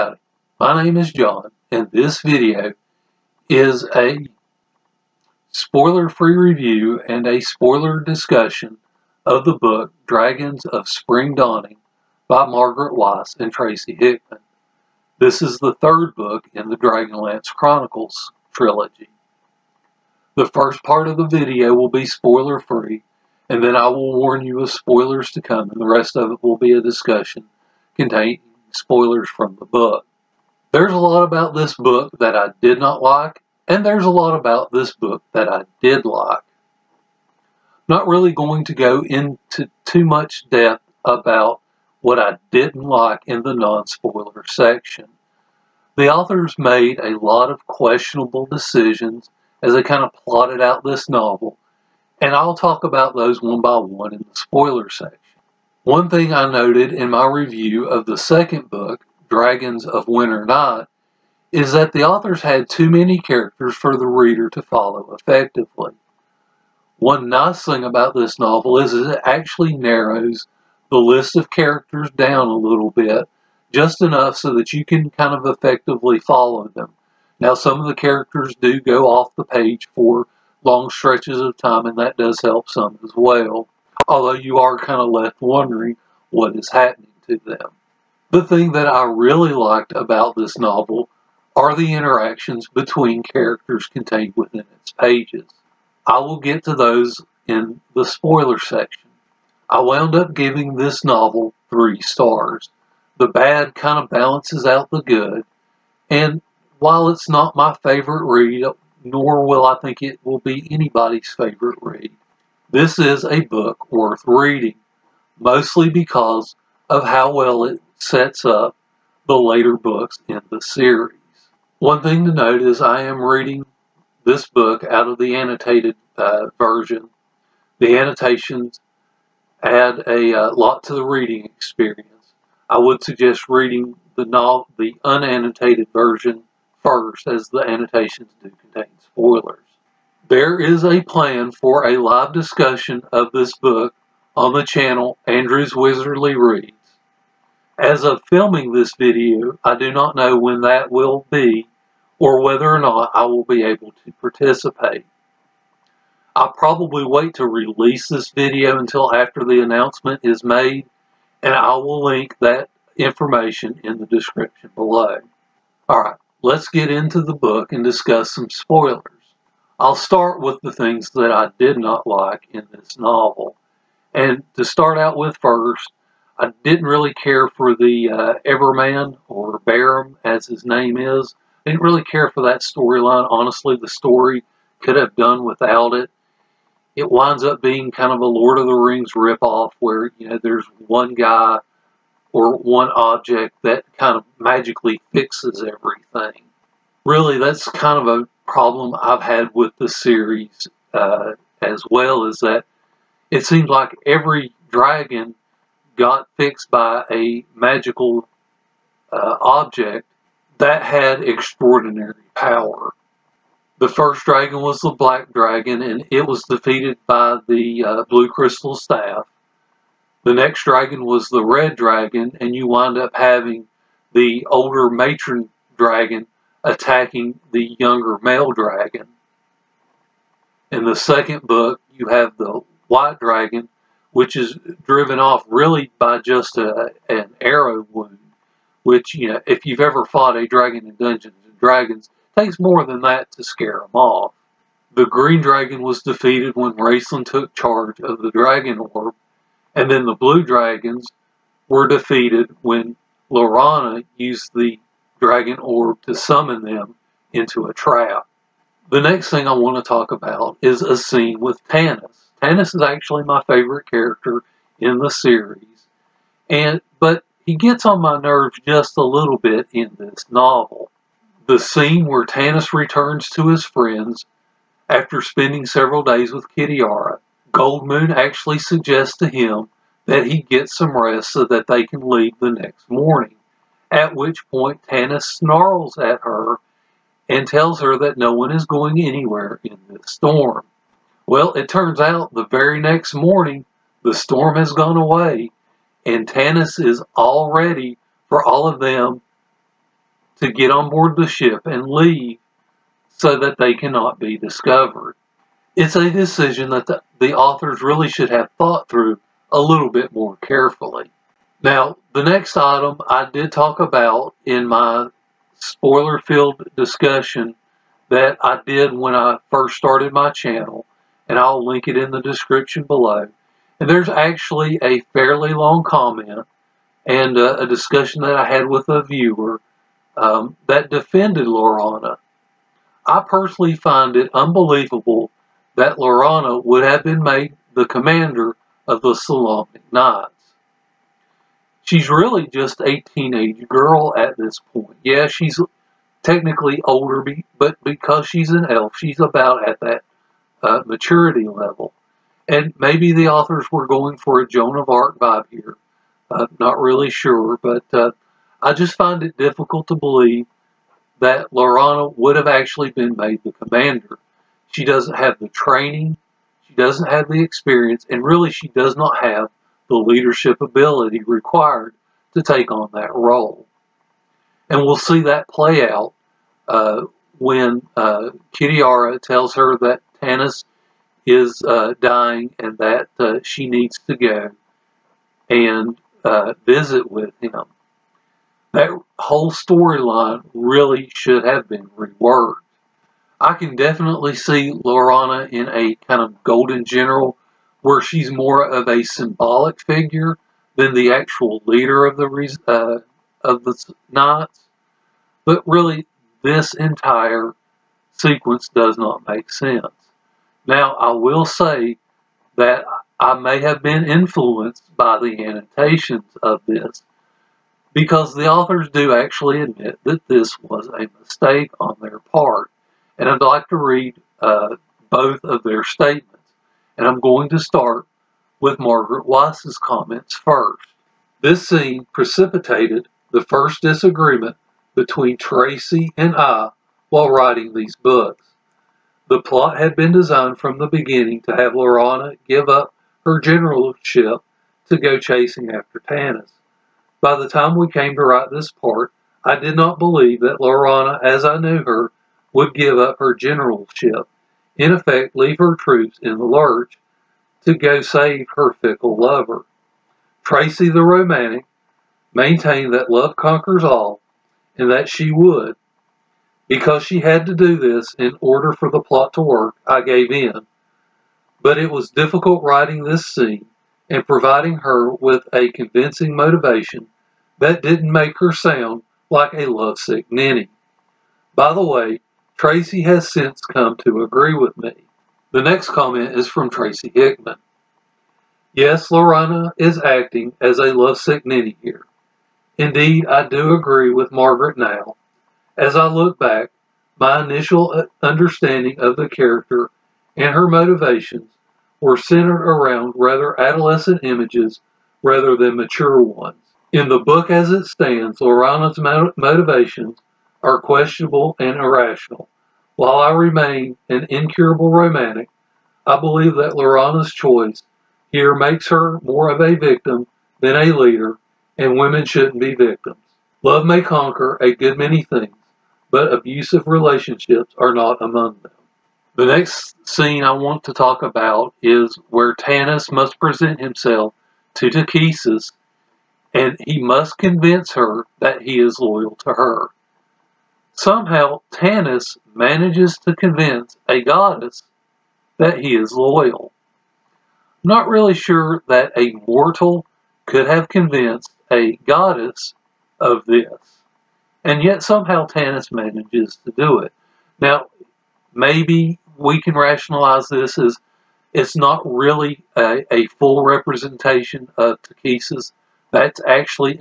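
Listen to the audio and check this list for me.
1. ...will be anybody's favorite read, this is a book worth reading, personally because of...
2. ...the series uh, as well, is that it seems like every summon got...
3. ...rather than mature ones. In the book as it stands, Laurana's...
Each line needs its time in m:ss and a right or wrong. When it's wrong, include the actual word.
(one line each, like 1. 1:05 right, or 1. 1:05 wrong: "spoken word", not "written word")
1. 1:50 wrong: "mostly", not "personally"
2. 3:19 wrong: "dragon", not "summon"
3. 8:25 right.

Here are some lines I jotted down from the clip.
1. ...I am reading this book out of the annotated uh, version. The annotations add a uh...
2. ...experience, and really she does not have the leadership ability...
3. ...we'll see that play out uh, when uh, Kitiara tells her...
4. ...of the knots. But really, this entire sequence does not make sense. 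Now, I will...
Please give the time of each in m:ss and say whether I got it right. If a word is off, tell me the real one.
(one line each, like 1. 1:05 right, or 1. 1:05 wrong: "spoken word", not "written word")
1. 2:02 right
2. 6:07 right
3. 6:14 right
4. 6:43 right.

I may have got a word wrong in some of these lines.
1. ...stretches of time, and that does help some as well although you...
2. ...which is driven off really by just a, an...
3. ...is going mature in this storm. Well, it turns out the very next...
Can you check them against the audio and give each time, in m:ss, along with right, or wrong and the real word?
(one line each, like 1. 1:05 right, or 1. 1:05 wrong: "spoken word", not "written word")
1. 1:20 right
2. 3:54 right
3. 4:48 wrong: "anywhere", not "mature".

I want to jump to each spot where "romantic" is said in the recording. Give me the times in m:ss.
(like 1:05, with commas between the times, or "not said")
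7:41, 8:34.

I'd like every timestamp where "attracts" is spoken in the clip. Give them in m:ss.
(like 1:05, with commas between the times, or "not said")
not said.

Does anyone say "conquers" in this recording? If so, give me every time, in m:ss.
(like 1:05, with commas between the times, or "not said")
7:43, 8:44.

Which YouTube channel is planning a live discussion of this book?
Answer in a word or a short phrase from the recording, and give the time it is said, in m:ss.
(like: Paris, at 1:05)
Andrew's Wizardly Reads, at 2:25.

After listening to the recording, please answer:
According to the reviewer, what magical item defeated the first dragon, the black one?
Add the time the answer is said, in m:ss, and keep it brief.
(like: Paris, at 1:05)
blue crystal staff, at 3:38.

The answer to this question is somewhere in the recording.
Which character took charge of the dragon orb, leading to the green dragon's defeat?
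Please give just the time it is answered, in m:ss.
4:06.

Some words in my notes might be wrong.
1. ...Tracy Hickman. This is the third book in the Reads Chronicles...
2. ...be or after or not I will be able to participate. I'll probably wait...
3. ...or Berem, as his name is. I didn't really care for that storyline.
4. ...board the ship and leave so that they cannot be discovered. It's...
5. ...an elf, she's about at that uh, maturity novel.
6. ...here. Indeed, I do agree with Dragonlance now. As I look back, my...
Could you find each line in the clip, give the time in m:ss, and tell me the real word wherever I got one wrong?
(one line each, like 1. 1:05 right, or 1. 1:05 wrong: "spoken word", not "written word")
1. 0:13 wrong: "Dragonlance", not "Reads"
2. 2:31 wrong: "whether", not "after"
3. 2:59 right
4. 5:00 right
5. 5:48 wrong: "level", not "novel"
6. 8:11 wrong: "Margaret", not "Dragonlance".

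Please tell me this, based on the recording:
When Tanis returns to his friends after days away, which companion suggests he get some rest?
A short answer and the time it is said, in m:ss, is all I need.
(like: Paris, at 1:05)
Goldmoon, at 4:37.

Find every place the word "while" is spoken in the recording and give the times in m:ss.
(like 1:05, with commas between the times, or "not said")
1:46, 7:17, 8:32.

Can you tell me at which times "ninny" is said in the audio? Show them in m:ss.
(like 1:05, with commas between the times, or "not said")
8:00, 8:11.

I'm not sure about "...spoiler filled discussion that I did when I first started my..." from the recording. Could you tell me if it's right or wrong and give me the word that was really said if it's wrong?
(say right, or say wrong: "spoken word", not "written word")
right.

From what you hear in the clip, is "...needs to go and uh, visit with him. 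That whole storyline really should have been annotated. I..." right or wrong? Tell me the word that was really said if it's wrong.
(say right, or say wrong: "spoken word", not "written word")
wrong: "reworked", not "annotated".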